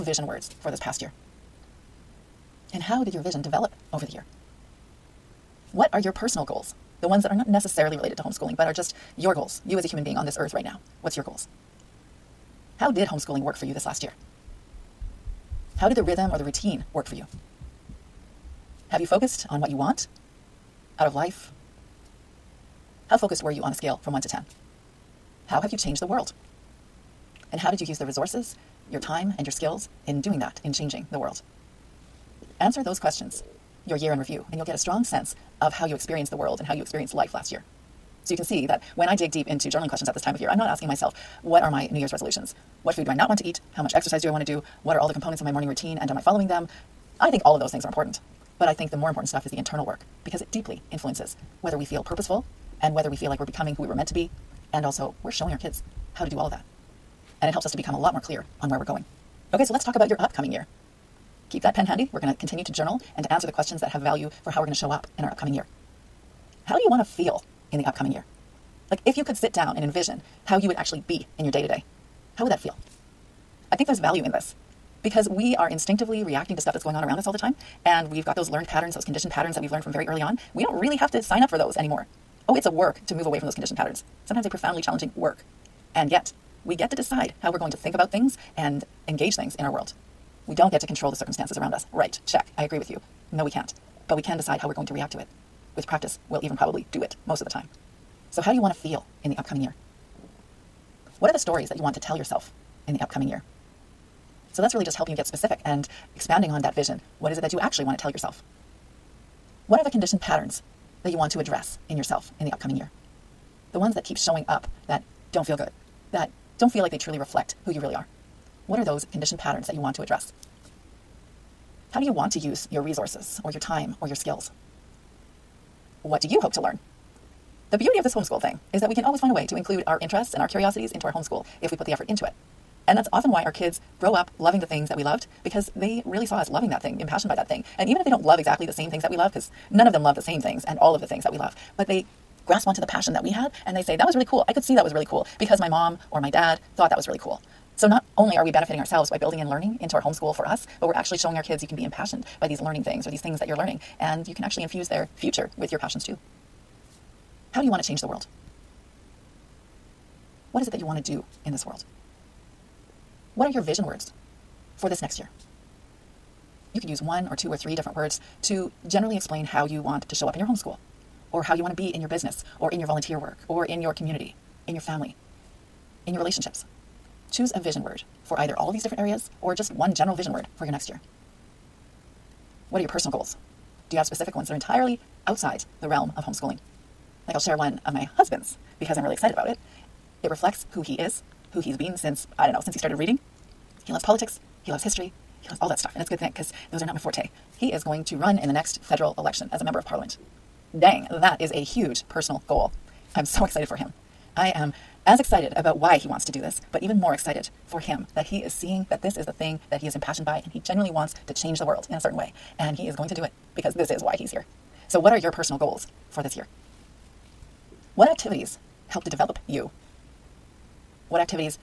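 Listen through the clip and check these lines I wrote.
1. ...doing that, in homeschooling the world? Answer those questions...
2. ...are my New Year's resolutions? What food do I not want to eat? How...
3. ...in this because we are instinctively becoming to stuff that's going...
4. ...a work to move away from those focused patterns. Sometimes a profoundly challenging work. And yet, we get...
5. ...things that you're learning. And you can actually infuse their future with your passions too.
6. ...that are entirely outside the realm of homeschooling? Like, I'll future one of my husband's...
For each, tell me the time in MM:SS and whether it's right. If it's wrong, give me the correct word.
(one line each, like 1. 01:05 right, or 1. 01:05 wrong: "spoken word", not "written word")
1. 00:30 wrong: "changing", not "homeschooling"
2. 00:41 right
3. 01:14 wrong: "reacting", not "becoming"
4. 01:22 wrong: "conditioned", not "focused"
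5. 02:33 right
6. 03:04 wrong: "share", not "future".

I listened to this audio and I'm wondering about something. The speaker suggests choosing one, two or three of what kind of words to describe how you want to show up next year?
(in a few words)
vision words.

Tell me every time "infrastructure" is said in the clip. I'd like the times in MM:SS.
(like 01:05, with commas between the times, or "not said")
not said.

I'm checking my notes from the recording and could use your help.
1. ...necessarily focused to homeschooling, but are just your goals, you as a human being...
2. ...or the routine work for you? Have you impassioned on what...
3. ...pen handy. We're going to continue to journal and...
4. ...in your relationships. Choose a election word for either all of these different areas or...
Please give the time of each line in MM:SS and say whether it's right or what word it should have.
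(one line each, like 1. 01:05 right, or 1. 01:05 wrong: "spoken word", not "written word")
1. 00:07 wrong: "related", not "focused"
2. 00:16 wrong: "focused", not "impassioned"
3. 01:01 right
4. 02:56 wrong: "vision", not "election".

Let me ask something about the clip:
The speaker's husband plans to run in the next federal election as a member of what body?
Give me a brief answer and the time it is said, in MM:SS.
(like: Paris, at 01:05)
parliament, at 03:19.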